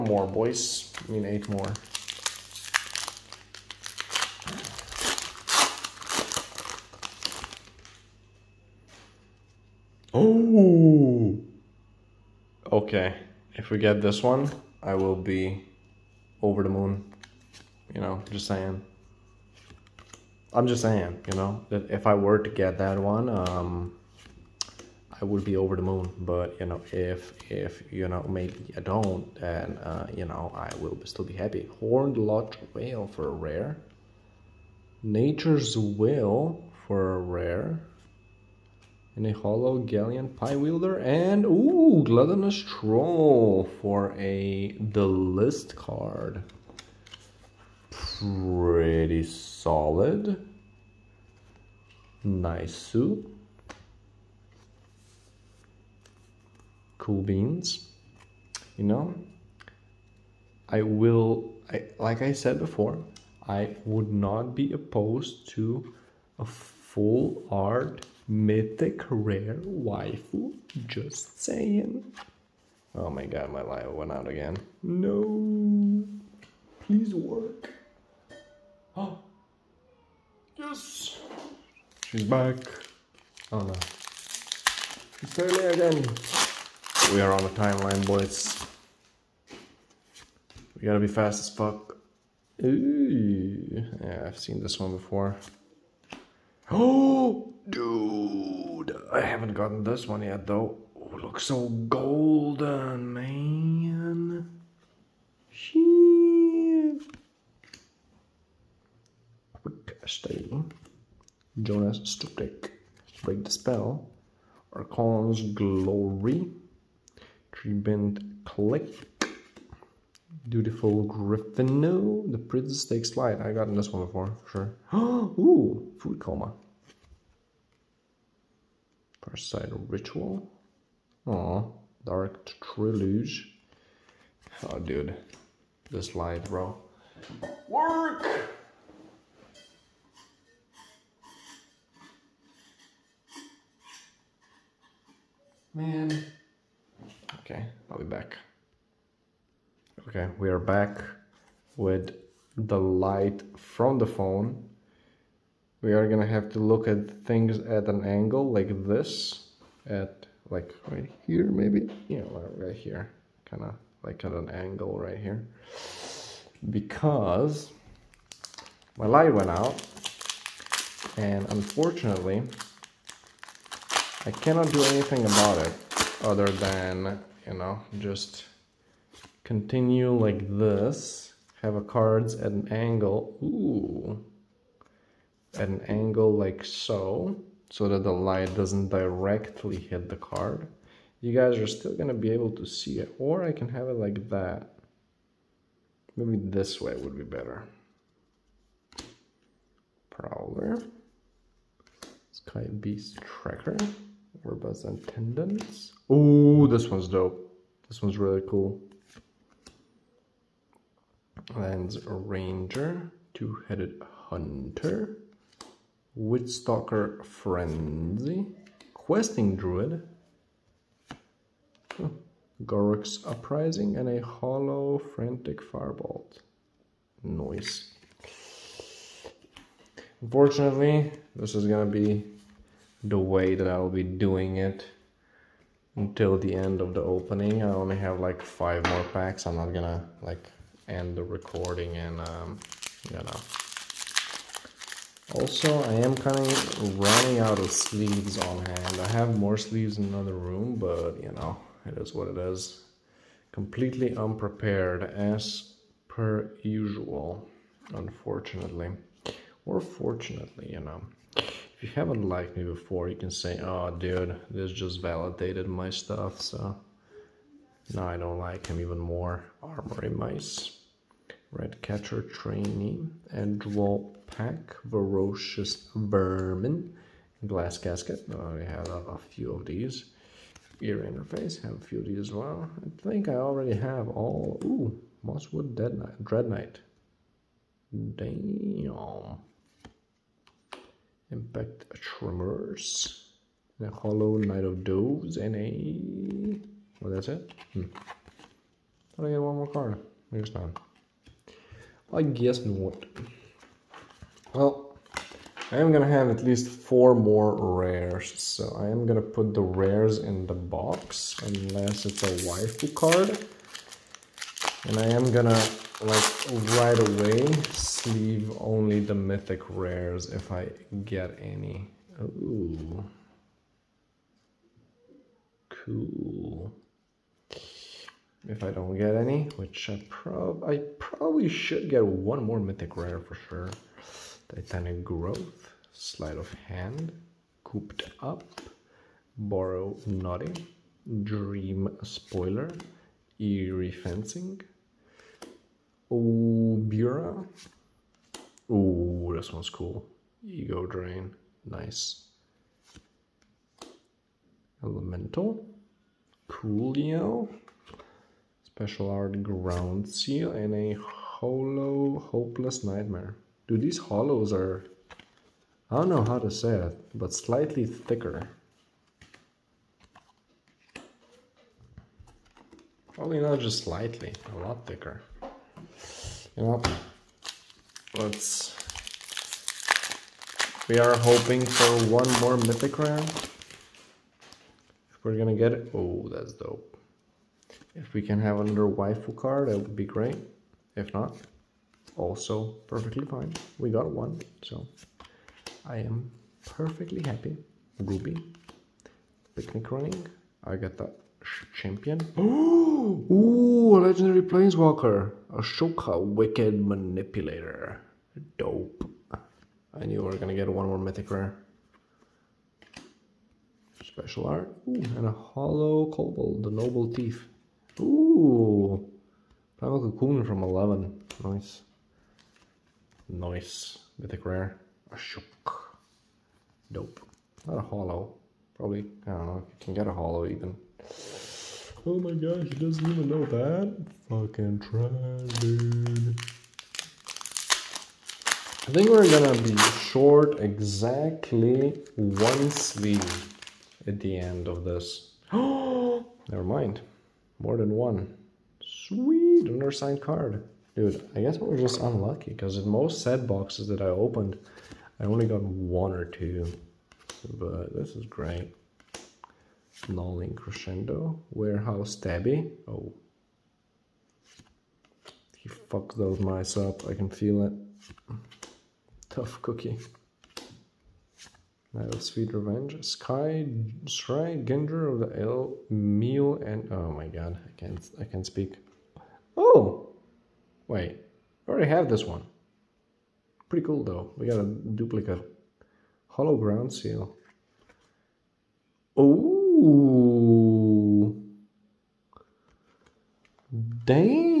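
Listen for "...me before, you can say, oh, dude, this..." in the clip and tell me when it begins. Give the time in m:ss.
4:22.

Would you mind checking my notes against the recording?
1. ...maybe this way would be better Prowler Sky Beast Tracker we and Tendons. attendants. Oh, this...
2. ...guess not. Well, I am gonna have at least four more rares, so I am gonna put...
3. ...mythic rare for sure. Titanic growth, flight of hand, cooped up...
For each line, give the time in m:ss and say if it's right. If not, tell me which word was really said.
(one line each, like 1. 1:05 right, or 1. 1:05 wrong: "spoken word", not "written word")
1. 3:16 right
2. 5:02 right
3. 5:32 wrong: "sleight", not "flight".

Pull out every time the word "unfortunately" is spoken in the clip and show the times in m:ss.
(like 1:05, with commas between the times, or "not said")
2:51, 3:50, 4:17.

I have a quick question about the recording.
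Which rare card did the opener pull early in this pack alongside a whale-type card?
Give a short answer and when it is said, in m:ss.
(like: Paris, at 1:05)
Nature's Will, at 0:35.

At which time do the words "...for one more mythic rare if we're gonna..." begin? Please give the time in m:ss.
6:21.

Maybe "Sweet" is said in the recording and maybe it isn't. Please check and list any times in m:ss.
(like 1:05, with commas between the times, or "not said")
7:28, 7:52.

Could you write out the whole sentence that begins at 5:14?
And I am gonna like right away sleeve only the mythic rares if I get any.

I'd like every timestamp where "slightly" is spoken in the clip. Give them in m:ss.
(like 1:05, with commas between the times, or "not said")
6:07, 6:13.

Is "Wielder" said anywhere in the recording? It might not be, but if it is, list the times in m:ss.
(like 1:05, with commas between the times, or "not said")
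0:40.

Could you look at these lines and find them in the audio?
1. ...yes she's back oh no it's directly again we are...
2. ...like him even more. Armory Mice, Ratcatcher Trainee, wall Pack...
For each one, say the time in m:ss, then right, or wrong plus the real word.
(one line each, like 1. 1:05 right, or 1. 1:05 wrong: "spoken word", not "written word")
1. 1:20 wrong: "early", not "directly"
2. 4:28 right.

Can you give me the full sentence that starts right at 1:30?
We gotta be fast as fuck.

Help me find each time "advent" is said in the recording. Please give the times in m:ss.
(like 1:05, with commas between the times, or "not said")
not said.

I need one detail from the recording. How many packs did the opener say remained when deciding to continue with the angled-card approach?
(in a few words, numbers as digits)
5.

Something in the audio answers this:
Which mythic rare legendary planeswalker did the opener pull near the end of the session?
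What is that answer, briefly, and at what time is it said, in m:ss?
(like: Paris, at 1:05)
Ashiok, Wicked Manipulator, at 6:45.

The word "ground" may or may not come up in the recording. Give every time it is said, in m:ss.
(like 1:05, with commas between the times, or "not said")
5:59, 8:06.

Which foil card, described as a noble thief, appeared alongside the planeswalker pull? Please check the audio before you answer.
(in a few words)
Kobold, the noble thief.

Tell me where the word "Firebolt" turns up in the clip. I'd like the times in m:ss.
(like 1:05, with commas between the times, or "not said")
3:45.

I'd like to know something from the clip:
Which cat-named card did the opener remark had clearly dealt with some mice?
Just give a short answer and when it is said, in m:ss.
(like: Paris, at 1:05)
Warehouse Tabby, at 7:41.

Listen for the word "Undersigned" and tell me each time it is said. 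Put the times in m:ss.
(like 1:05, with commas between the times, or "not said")
7:29.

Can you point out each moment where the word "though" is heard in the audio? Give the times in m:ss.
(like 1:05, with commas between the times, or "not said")
1:40, 8:04.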